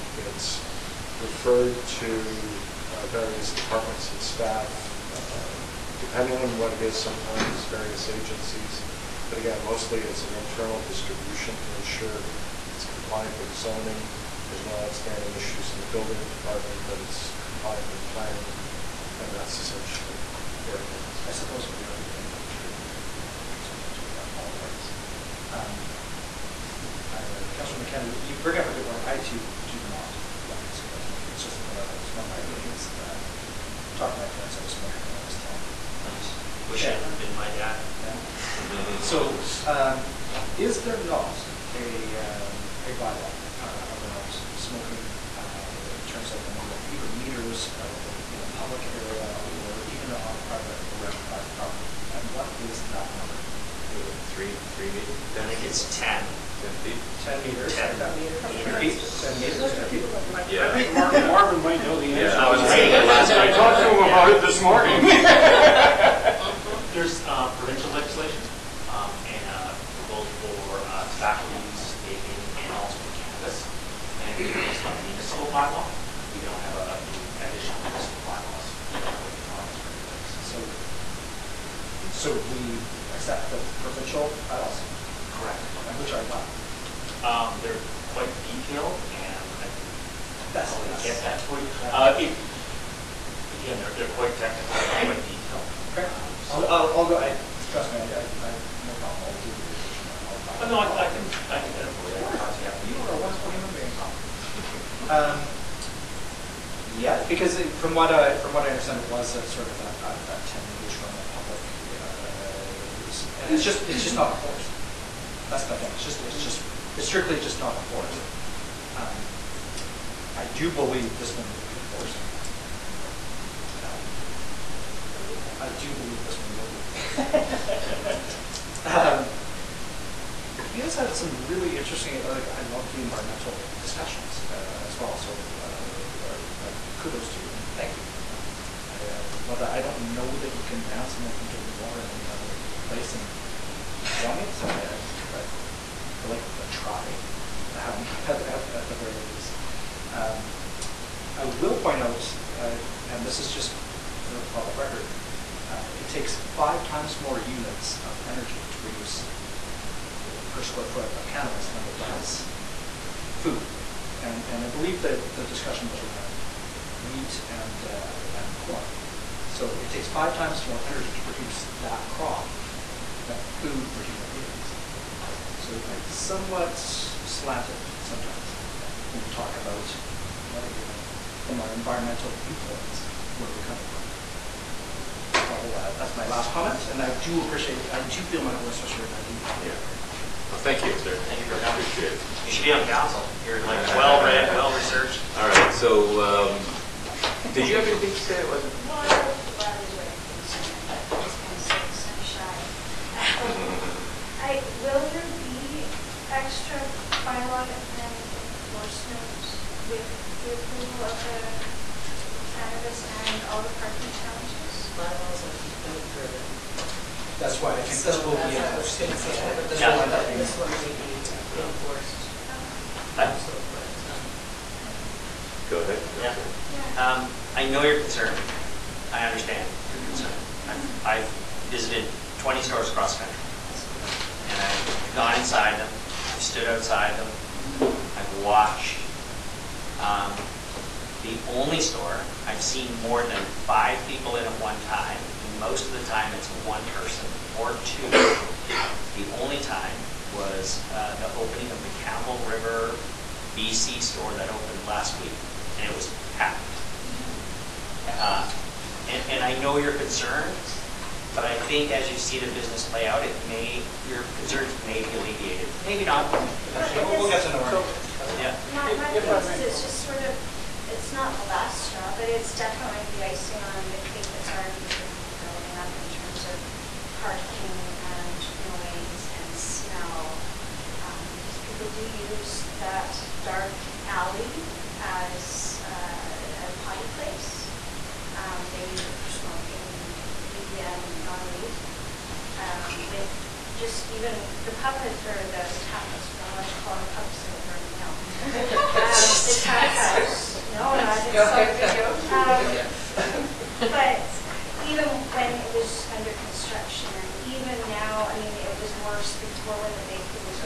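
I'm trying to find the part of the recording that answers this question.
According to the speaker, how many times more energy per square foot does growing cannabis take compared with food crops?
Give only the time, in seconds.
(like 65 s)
156 s.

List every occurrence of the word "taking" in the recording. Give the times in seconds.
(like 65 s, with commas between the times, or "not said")
141 s.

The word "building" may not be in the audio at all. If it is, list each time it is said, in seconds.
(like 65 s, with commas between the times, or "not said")
15 s, 275 s.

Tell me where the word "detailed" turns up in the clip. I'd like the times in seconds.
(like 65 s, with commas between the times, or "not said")
88 s, 95 s.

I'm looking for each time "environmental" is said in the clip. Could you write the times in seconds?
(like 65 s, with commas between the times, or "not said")
133 s, 181 s.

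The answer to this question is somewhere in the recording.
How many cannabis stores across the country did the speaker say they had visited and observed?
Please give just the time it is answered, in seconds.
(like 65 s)
232 s.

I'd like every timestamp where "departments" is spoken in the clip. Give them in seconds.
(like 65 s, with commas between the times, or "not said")
3 s, 16 s.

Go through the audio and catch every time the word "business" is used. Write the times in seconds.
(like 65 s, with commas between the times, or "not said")
262 s, 269 s.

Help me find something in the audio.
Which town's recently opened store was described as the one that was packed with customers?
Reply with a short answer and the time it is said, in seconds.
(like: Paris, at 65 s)
Campbell River, at 251 s.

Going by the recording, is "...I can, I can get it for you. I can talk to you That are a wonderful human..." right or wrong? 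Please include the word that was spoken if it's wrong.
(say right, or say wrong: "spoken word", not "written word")
wrong: "You", not "That".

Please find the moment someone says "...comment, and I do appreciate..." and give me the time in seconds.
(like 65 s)
186 s.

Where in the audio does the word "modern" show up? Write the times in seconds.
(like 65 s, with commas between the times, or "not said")
not said.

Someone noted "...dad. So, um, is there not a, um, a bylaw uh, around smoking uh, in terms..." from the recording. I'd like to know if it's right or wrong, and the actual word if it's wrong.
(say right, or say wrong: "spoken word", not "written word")
right.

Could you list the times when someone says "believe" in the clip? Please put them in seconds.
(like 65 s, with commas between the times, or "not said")
120 s, 125 s, 164 s.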